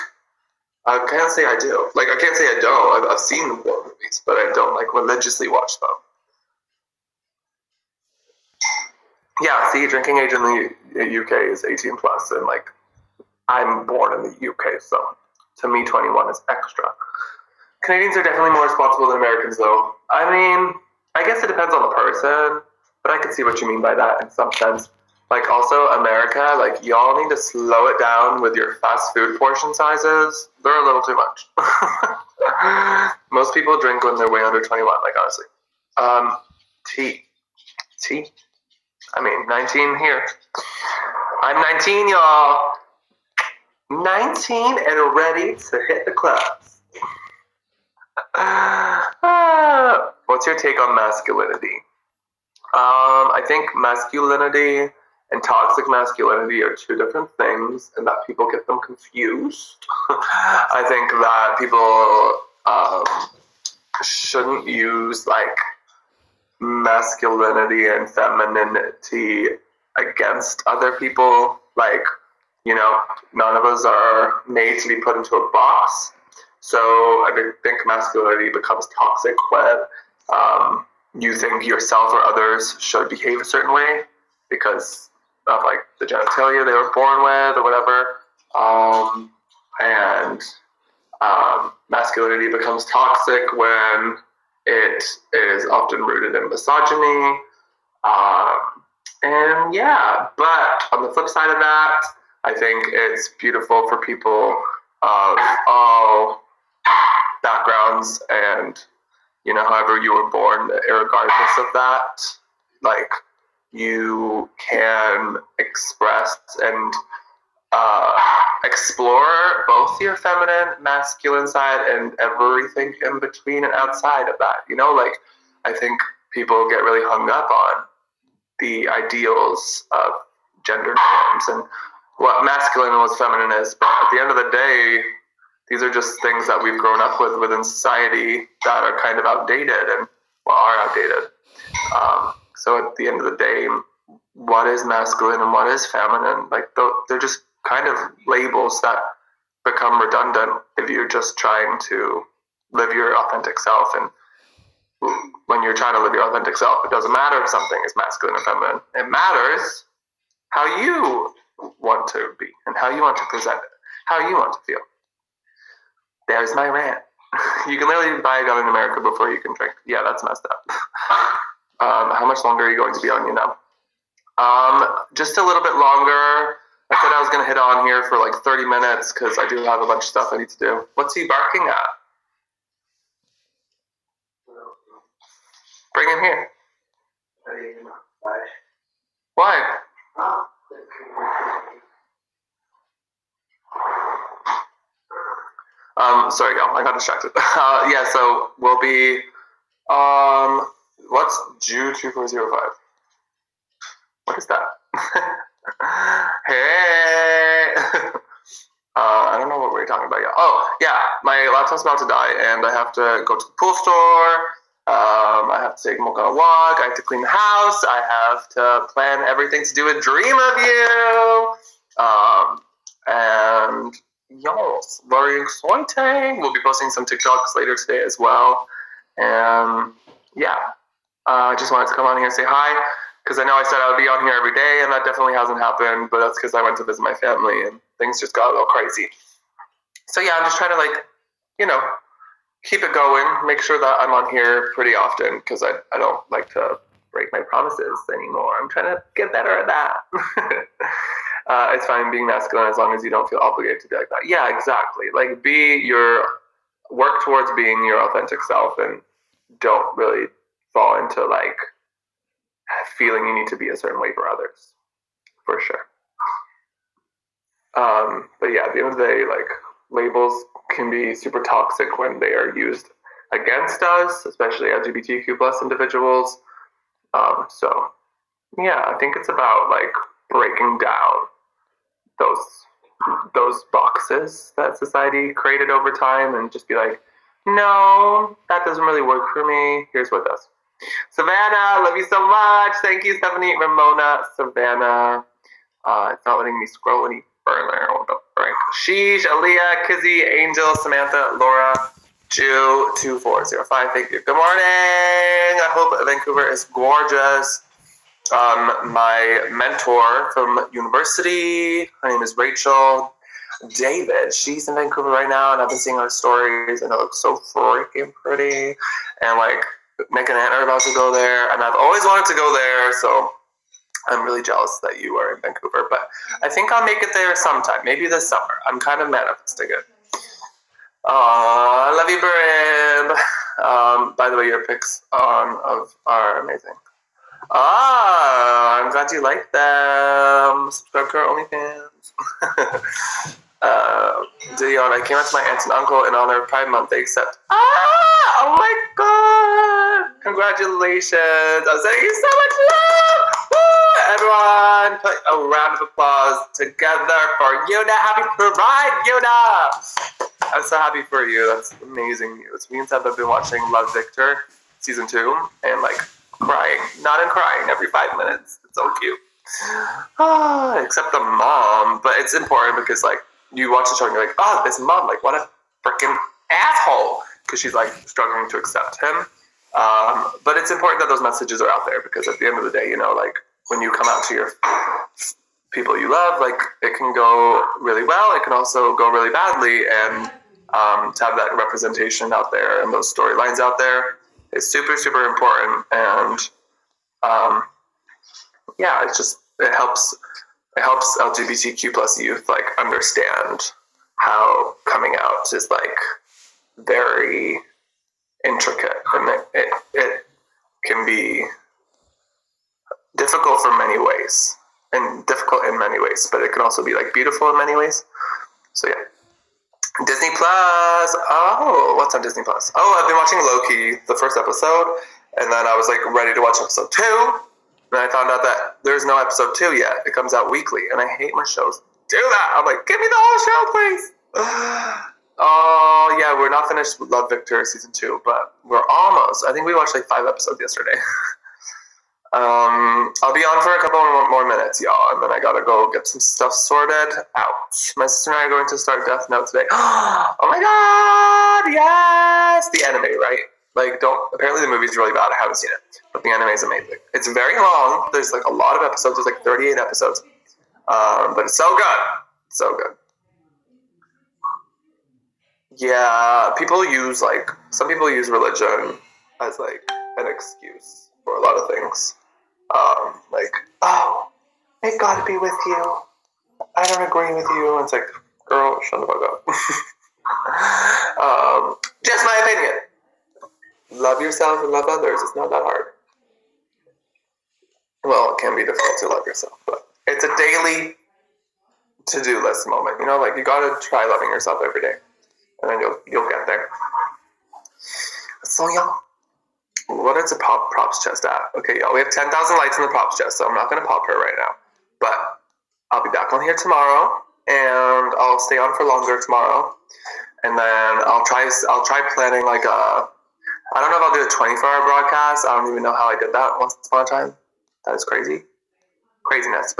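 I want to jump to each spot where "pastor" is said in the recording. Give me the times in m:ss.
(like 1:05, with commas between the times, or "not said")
not said.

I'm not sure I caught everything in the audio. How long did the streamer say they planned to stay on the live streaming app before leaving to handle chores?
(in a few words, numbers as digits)
30 minutes.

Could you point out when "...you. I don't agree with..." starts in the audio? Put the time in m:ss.
7:55.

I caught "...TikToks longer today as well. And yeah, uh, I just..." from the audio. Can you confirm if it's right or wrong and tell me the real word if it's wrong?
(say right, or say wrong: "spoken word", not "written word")
wrong: "later", not "longer".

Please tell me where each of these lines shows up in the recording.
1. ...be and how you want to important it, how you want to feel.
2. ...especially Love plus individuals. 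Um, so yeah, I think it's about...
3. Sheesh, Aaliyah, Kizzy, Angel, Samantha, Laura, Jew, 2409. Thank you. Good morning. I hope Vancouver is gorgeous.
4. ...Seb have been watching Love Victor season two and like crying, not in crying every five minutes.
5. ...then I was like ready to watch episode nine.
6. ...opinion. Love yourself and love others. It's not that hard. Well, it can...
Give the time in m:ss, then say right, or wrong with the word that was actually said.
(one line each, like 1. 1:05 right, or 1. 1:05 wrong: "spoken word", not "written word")
1. 2:42 wrong: "present", not "important"
2. 4:34 wrong: "LGBTQ", not "Love"
3. 4:58 wrong: "2405", not "2409"
4. 6:02 right
5. 7:05 wrong: "two", not "nine"
6. 8:02 right.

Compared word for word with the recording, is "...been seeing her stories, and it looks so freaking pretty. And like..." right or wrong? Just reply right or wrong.
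right.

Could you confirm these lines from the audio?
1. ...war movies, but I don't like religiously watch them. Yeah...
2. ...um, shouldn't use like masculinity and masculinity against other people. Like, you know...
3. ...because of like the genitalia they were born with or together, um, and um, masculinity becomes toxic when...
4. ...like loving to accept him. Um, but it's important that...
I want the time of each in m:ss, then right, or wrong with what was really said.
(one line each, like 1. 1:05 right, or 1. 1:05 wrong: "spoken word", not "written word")
1. 0:03 right
2. 1:02 wrong: "femininity", not "masculinity"
3. 1:24 wrong: "whatever", not "together"
4. 6:17 wrong: "struggling", not "loving".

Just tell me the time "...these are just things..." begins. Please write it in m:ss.
2:15.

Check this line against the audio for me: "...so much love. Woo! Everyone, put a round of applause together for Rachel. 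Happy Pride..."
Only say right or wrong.
wrong.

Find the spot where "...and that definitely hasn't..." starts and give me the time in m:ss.
3:54.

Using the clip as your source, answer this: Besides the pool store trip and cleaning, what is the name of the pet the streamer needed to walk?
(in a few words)
Mocha.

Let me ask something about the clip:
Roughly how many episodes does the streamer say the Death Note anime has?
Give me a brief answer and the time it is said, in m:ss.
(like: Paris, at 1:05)
38, at 7:39.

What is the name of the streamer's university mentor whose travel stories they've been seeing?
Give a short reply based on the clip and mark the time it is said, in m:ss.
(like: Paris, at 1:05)
Rachel David, at 5:12.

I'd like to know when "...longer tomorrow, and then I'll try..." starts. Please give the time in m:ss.
8:28.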